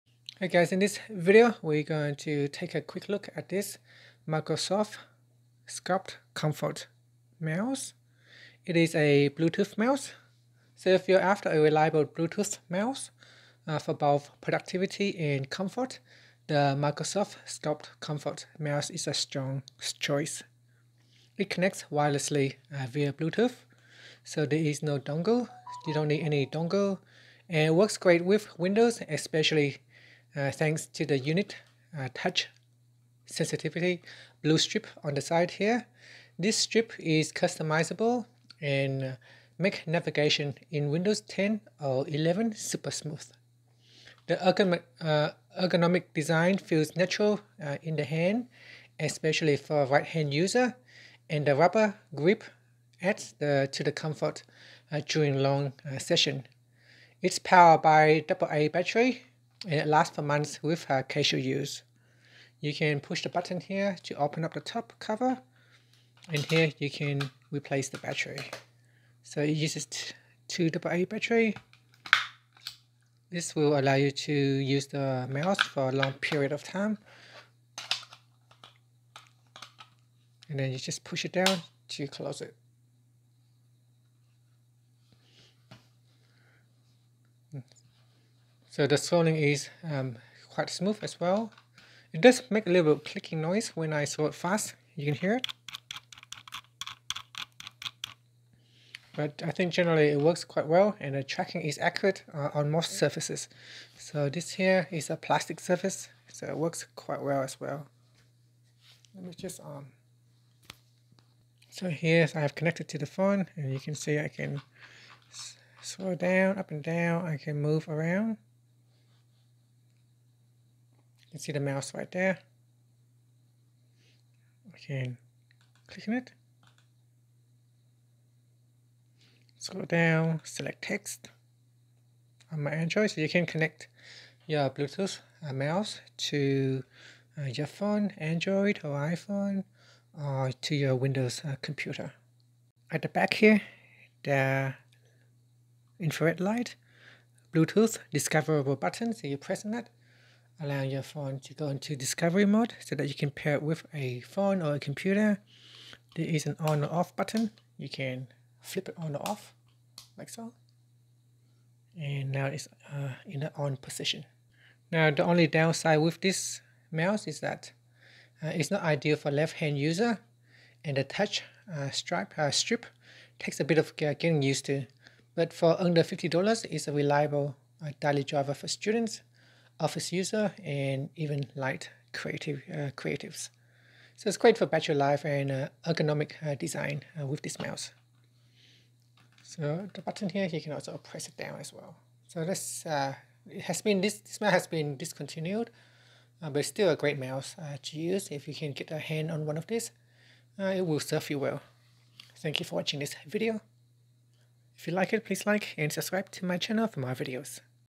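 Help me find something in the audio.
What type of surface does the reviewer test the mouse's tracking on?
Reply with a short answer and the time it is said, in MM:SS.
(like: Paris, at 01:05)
plastic, at 01:45.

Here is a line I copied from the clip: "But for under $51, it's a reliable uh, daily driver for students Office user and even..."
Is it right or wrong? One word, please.
wrong.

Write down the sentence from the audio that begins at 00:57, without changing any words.
It's powered by AA battery it lasts for months with have casual use.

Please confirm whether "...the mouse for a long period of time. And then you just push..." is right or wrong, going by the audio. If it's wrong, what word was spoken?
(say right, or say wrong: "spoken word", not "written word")
right.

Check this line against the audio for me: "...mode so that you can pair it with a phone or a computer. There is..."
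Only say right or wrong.
right.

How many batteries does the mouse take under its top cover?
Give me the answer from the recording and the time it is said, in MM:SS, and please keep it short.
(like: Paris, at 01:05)
2, at 01:10.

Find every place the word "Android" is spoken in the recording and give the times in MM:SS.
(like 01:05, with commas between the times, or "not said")
02:12, 02:18.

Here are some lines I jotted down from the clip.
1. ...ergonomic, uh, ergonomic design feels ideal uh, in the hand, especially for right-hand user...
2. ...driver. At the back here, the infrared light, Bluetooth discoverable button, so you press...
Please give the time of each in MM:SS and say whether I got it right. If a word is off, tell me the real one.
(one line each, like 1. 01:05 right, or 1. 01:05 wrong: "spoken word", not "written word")
1. 00:44 wrong: "natural", not "ideal"
2. 02:21 wrong: "computer", not "driver".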